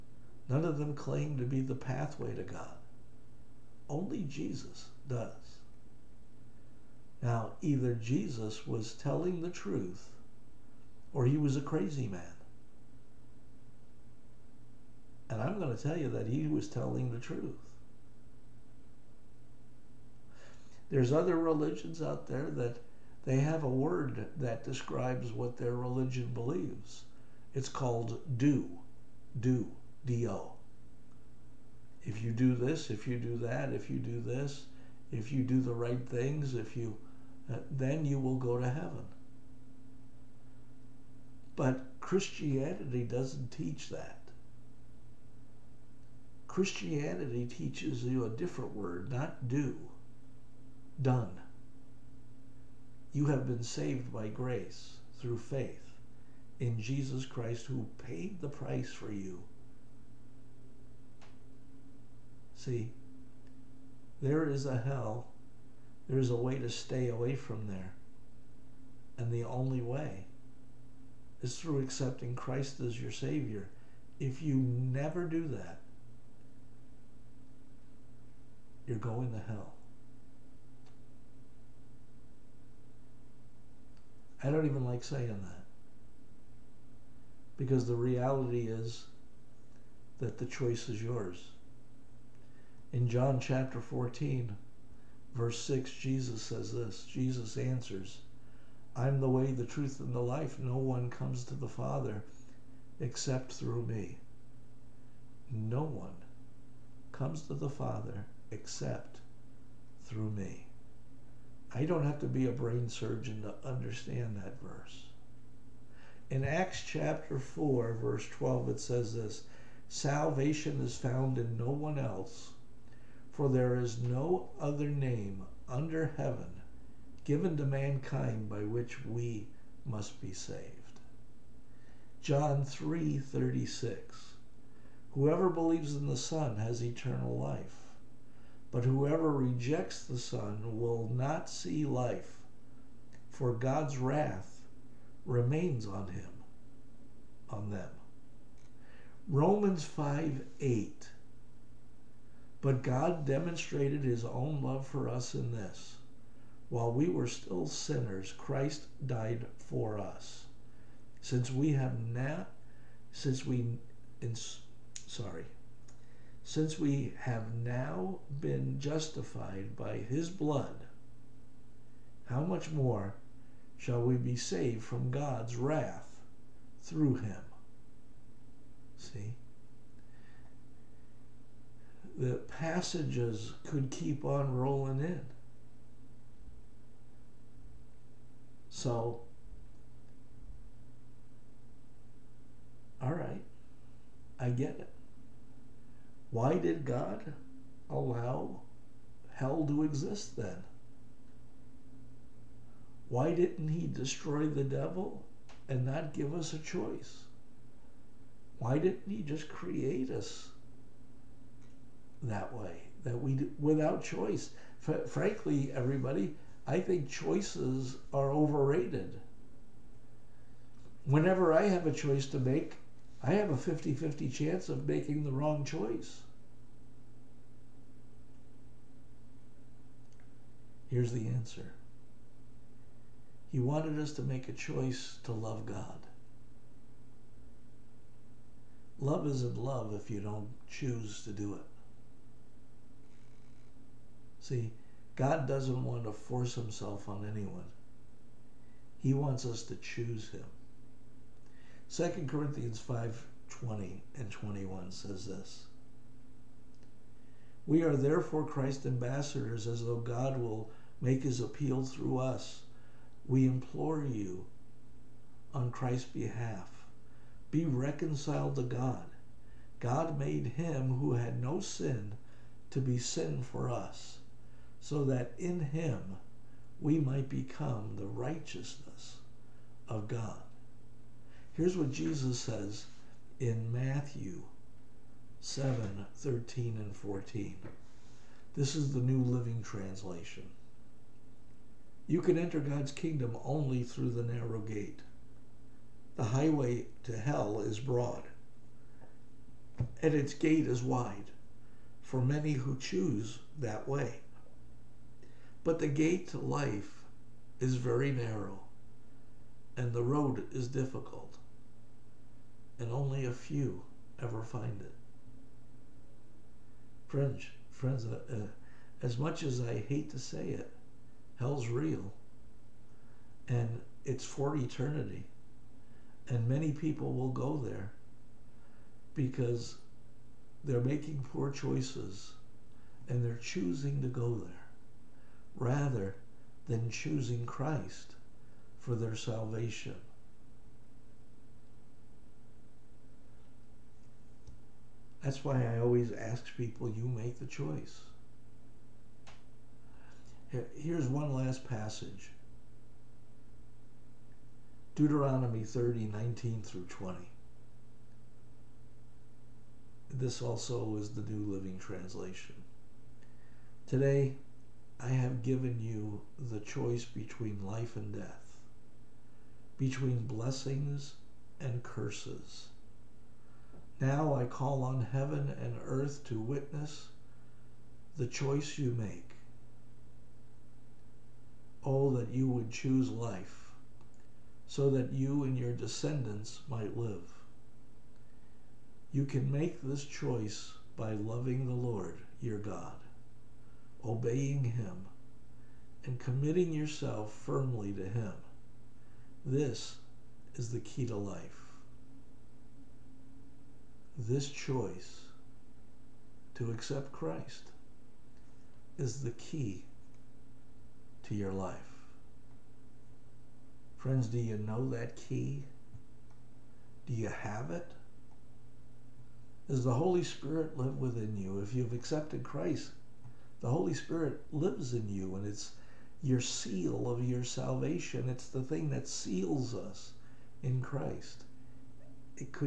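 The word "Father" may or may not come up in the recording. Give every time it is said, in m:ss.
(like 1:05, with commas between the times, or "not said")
1:41, 1:47.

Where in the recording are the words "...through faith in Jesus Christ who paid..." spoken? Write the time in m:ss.
0:55.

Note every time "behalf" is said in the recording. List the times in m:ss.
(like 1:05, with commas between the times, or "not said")
4:26.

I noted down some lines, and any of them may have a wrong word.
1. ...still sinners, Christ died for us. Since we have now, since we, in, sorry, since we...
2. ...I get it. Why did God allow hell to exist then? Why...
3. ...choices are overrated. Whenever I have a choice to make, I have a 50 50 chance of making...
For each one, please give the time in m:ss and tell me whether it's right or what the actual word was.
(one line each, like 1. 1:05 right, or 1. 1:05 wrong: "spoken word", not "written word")
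1. 2:37 right
2. 3:14 right
3. 3:37 right.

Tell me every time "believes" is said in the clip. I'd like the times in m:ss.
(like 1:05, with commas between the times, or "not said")
0:26, 2:15.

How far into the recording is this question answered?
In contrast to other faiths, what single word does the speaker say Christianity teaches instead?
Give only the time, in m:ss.
0:49.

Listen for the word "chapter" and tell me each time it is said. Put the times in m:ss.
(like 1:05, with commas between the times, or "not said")
1:33, 1:56.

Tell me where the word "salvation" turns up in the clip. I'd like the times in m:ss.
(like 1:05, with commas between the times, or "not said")
1:59, 5:39, 7:07.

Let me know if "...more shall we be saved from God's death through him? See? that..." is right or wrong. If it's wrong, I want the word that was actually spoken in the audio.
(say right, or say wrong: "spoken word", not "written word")
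wrong: "wrath", not "death".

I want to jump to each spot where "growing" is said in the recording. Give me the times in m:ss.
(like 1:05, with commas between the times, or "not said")
not said.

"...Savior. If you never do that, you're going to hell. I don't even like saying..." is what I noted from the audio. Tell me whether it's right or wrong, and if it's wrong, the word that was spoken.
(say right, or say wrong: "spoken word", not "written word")
right.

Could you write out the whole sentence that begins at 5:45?
That's why I always ask people, you make the choice.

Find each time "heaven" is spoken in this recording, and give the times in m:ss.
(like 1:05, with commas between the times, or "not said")
0:38, 2:06, 6:15.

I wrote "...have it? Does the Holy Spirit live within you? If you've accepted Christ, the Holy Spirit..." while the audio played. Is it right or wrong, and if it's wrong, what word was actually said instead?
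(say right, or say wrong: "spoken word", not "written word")
right.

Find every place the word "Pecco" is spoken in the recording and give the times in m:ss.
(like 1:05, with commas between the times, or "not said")
not said.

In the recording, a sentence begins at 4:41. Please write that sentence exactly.
Here's what Jesus says in Matthew 7 13 and 14.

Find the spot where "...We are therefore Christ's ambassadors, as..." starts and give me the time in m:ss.
4:17.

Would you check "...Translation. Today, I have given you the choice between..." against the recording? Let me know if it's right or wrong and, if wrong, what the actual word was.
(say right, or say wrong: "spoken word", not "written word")
right.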